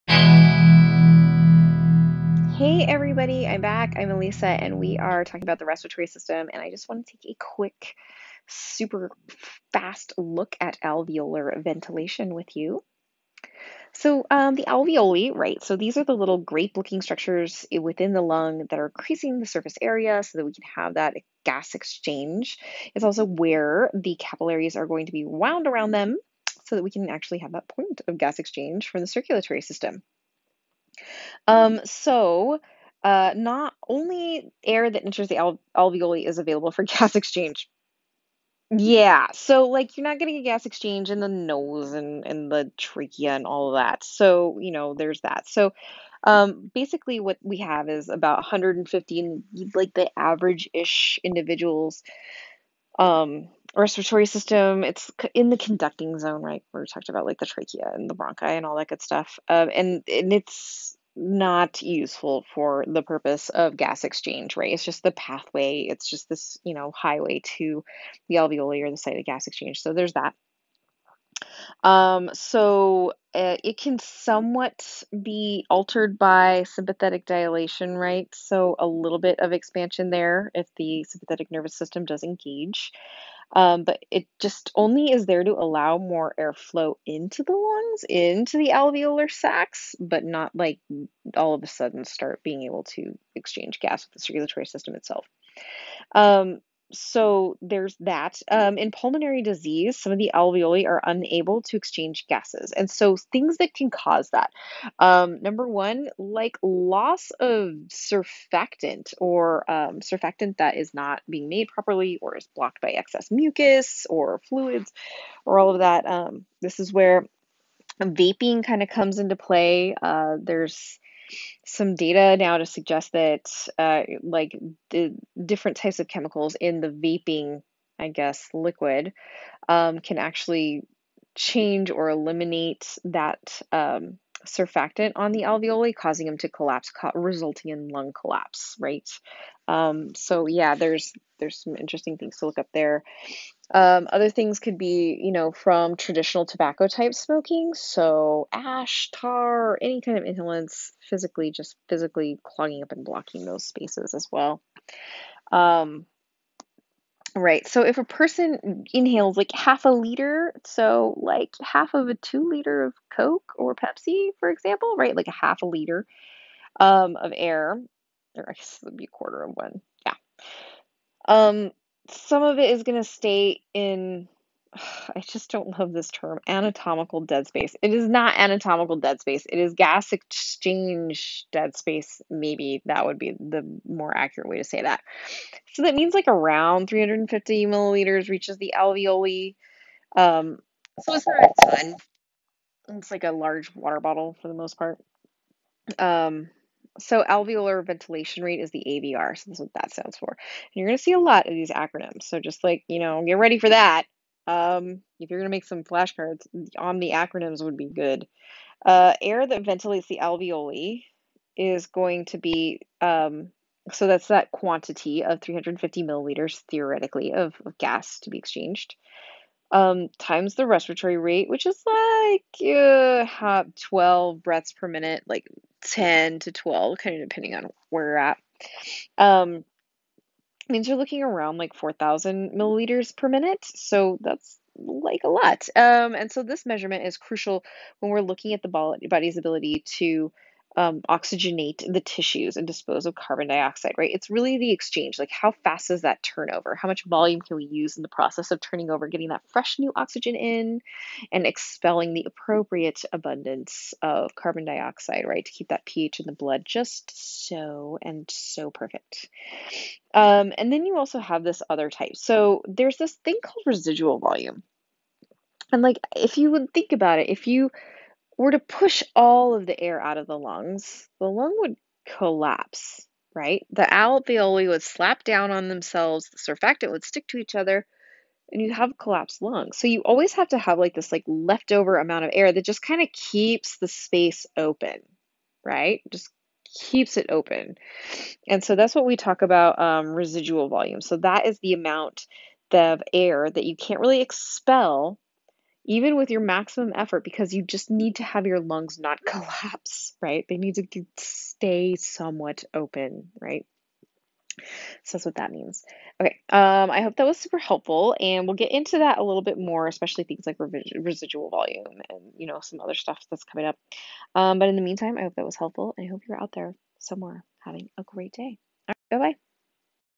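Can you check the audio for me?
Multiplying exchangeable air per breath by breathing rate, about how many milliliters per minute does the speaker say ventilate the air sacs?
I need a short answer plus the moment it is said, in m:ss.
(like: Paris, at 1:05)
4,000 milliliters per minute, at 3:51.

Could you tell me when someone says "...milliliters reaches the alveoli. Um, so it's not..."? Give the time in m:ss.
3:07.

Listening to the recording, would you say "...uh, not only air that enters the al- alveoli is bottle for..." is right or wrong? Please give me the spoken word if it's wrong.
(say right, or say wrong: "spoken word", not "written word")
wrong: "available", not "bottle".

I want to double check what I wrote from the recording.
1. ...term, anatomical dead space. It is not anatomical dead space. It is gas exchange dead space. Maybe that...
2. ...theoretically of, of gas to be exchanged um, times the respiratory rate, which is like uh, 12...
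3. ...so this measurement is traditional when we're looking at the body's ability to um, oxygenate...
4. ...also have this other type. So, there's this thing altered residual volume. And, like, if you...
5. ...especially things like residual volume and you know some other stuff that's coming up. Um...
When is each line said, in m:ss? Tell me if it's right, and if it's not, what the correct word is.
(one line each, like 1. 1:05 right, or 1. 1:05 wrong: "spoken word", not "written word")
1. 2:56 right
2. 3:36 right
3. 3:56 wrong: "crucial", not "traditional"
4. 4:20 wrong: "called", not "altered"
5. 5:09 right.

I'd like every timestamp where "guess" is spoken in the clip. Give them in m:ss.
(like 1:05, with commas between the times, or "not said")
2:08, 2:48.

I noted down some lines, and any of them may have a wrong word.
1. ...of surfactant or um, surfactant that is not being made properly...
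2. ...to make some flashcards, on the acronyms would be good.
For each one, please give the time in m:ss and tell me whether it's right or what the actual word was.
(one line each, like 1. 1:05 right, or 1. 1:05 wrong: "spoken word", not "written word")
1. 1:47 right
2. 3:25 right.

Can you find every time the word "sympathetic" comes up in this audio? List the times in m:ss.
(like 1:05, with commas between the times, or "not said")
1:16, 1:21.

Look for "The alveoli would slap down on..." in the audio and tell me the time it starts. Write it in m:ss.
4:33.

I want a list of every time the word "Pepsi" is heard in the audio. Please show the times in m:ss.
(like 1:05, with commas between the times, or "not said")
2:43.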